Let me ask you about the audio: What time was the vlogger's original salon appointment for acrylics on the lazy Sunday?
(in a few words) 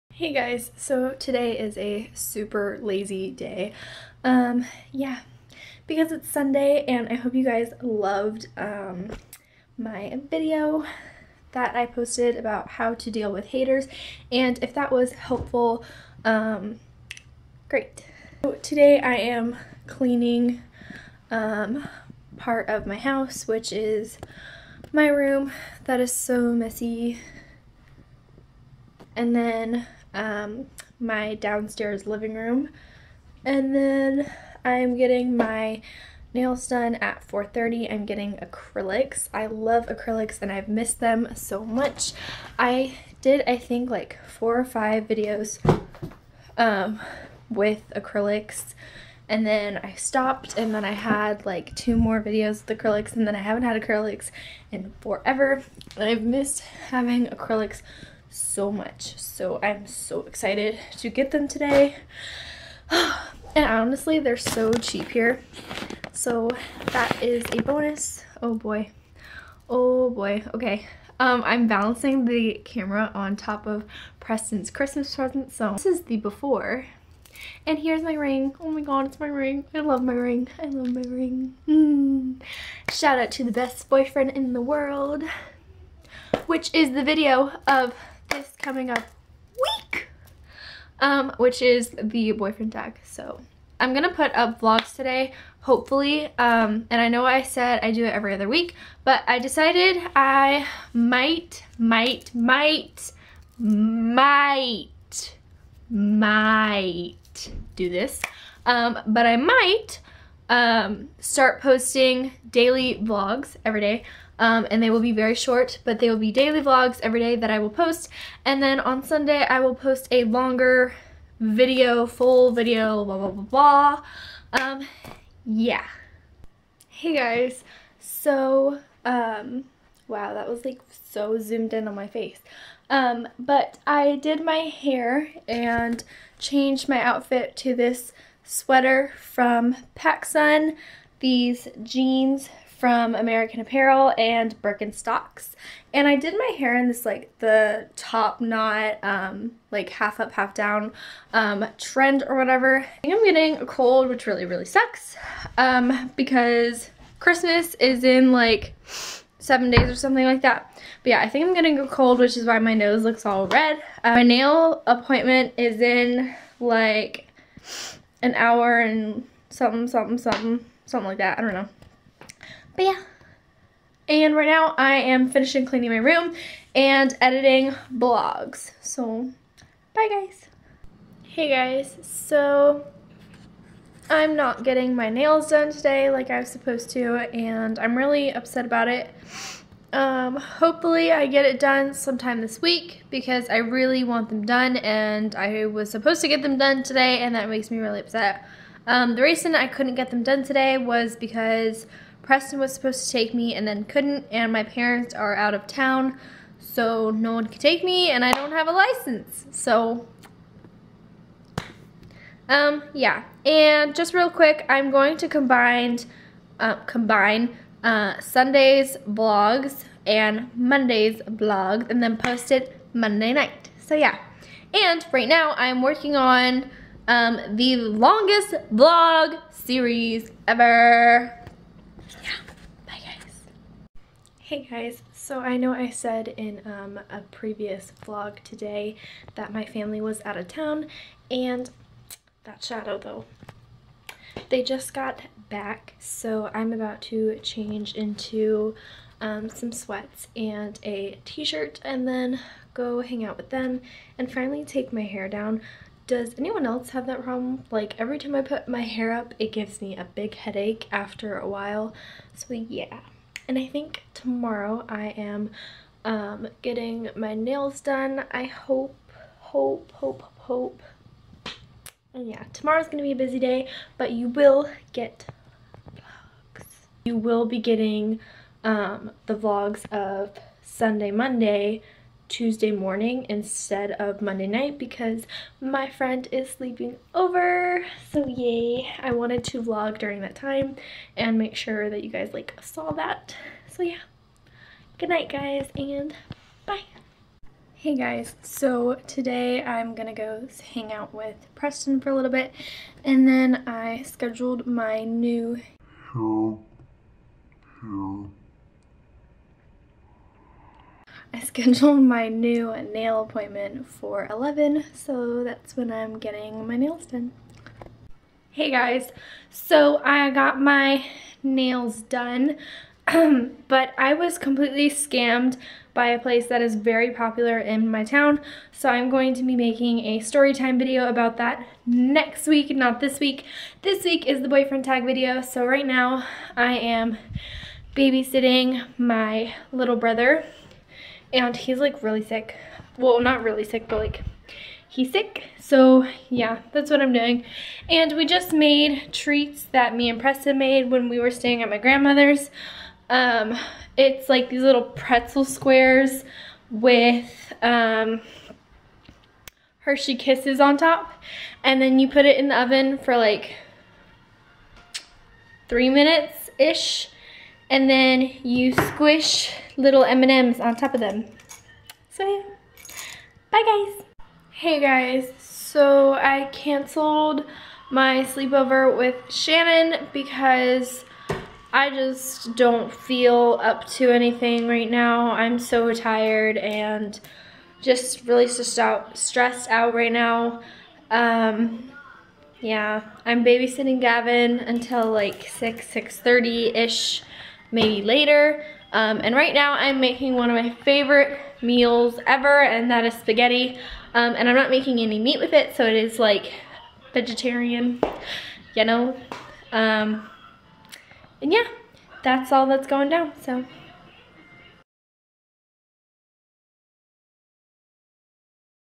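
4:30.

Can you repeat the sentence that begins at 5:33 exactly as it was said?
This week is the boyfriend tag video, so right now I am babysitting my little brother and he's like really sick.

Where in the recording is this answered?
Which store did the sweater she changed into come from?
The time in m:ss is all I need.
2:19.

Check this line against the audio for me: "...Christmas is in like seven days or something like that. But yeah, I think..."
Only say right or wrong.
right.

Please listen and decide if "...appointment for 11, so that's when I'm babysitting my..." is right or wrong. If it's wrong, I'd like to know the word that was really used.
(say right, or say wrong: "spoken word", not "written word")
wrong: "getting", not "babysitting".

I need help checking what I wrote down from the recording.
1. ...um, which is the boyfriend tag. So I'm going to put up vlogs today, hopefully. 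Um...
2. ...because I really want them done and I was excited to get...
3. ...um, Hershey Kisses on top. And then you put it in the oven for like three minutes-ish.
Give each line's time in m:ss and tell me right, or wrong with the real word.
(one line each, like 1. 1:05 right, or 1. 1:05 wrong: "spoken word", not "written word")
1. 1:30 right
2. 3:13 wrong: "supposed", not "excited"
3. 5:57 right.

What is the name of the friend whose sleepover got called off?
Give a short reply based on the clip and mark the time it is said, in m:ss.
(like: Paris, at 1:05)
Shannon, at 6:19.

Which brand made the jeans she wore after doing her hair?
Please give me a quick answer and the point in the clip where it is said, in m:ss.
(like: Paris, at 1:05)
American Apparel, at 2:23.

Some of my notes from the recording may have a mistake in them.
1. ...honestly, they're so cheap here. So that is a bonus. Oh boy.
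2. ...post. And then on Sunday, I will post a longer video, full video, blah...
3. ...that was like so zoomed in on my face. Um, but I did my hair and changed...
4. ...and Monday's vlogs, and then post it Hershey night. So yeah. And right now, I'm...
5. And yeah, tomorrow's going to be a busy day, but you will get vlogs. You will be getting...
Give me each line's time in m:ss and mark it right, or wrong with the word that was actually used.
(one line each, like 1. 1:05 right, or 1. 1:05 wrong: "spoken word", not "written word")
1. 1:03 right
2. 1:57 right
3. 2:10 right
4. 3:40 wrong: "Monday", not "Hershey"
5. 4:32 right.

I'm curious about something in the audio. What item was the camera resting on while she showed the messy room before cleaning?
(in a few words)
Preston's Christmas present.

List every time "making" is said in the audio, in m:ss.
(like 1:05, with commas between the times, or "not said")
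5:29, 6:40, 6:44.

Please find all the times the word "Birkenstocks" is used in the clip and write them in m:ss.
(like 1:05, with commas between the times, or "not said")
2:24.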